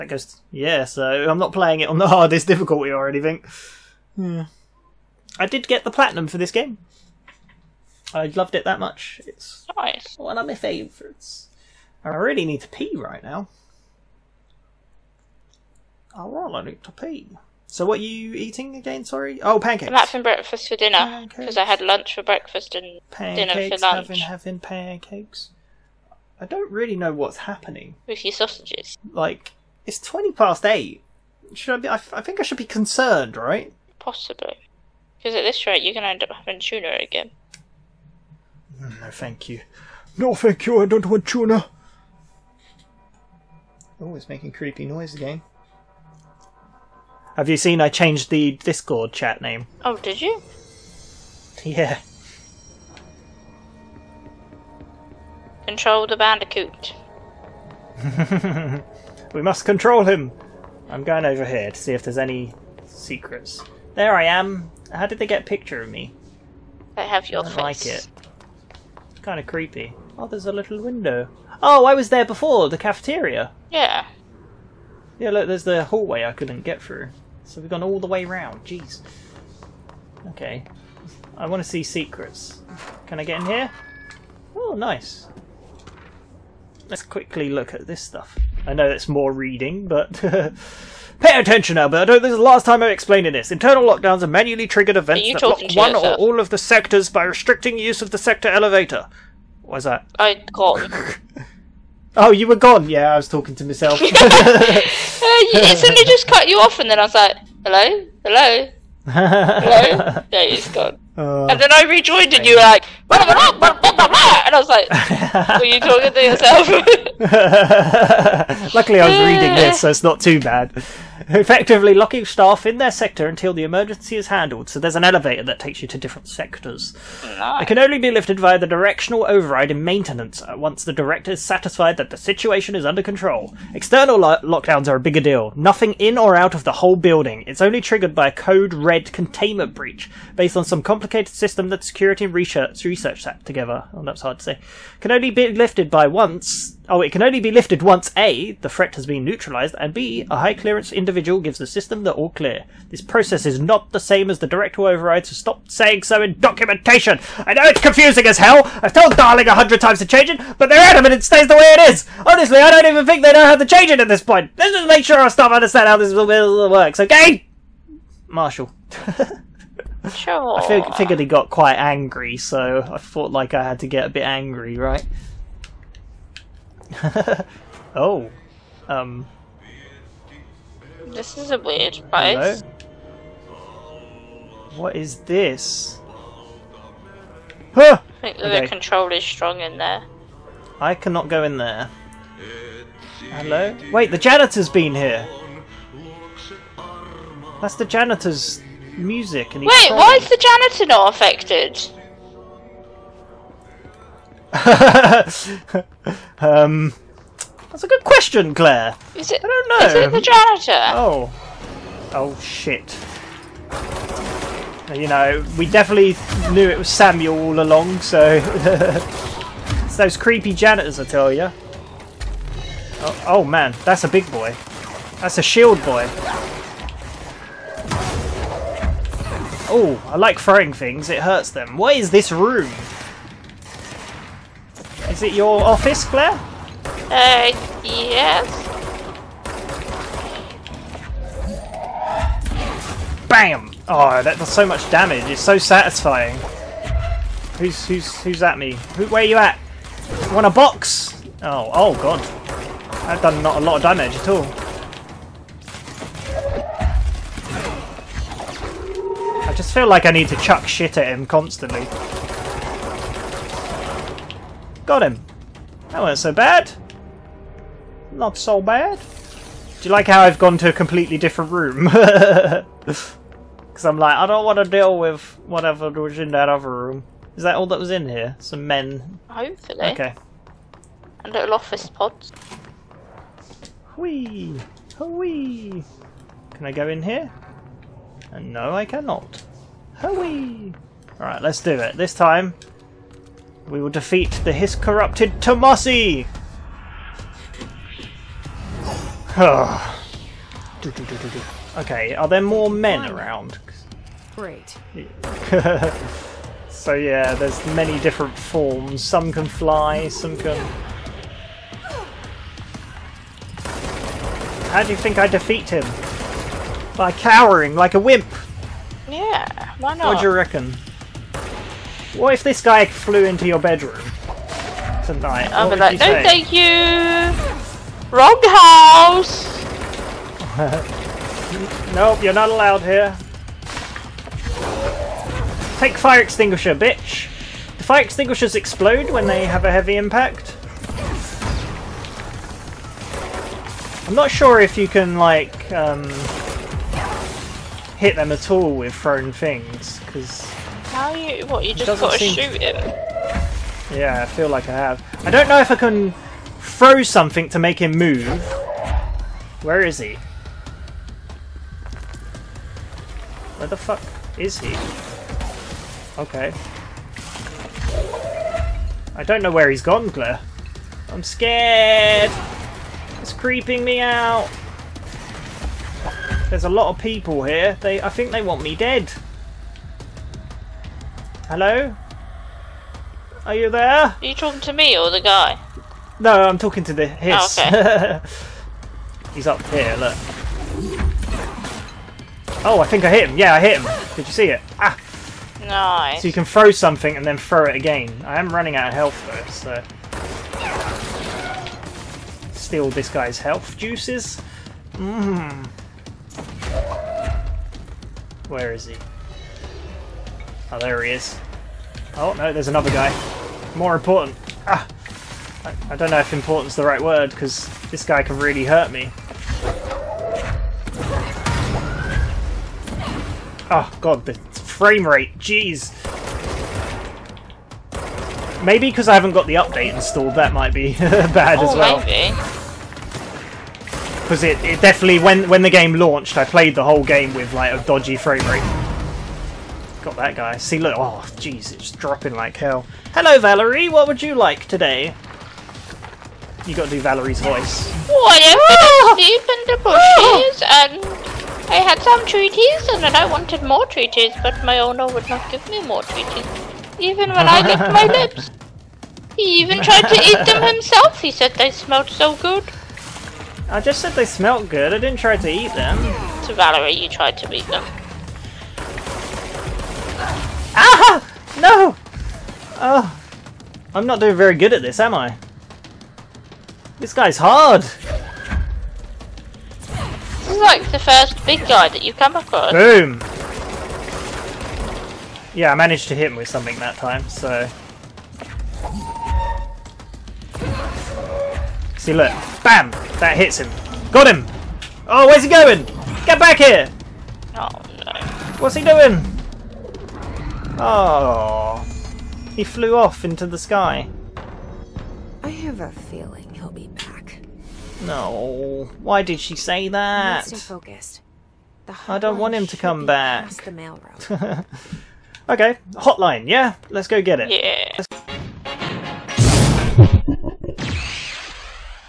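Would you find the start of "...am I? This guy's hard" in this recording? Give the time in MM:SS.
07:55.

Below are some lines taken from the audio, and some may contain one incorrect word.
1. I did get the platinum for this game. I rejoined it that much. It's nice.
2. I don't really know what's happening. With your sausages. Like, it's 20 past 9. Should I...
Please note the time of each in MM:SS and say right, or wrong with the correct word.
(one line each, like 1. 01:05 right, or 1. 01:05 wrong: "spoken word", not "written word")
1. 00:05 wrong: "loved", not "rejoined"
2. 00:26 wrong: "8", not "9".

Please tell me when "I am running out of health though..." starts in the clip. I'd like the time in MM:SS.
06:38.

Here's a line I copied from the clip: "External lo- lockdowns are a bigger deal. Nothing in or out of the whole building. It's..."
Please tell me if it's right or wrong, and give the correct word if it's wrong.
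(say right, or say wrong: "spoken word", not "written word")
right.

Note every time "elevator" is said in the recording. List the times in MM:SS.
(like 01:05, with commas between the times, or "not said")
01:38, 02:05.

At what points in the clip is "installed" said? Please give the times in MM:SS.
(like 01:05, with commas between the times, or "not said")
07:09.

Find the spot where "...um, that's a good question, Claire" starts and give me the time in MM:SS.
03:26.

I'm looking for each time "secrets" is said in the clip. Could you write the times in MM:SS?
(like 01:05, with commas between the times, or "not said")
01:02, 01:21.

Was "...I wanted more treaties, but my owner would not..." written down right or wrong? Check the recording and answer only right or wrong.
right.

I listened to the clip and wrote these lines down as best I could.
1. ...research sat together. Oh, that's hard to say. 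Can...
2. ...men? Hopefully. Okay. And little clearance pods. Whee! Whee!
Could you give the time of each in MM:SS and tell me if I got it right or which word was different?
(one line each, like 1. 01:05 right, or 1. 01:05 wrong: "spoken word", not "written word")
1. 02:22 right
2. 04:38 wrong: "office", not "clearance".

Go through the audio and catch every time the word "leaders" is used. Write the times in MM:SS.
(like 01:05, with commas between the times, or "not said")
not said.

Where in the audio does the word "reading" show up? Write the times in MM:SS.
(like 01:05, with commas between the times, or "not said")
01:29, 01:59.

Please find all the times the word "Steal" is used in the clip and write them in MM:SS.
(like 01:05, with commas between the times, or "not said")
06:42.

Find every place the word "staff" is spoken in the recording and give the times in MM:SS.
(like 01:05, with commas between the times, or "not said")
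02:02, 02:45.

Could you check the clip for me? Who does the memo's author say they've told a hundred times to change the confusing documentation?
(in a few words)
Darling.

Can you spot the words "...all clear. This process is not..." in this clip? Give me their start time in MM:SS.
02:32.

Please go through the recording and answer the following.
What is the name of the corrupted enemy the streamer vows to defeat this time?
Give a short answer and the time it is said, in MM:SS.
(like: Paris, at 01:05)
Tommasi, at 04:55.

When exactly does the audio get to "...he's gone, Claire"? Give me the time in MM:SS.
06:09.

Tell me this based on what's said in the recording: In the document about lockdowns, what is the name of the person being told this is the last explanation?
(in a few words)
Alberto.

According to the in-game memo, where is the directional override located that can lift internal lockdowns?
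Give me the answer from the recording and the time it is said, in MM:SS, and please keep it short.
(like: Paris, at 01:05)
Maintenance, at 02:09.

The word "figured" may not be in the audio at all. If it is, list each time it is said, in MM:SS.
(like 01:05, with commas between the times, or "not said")
02:50.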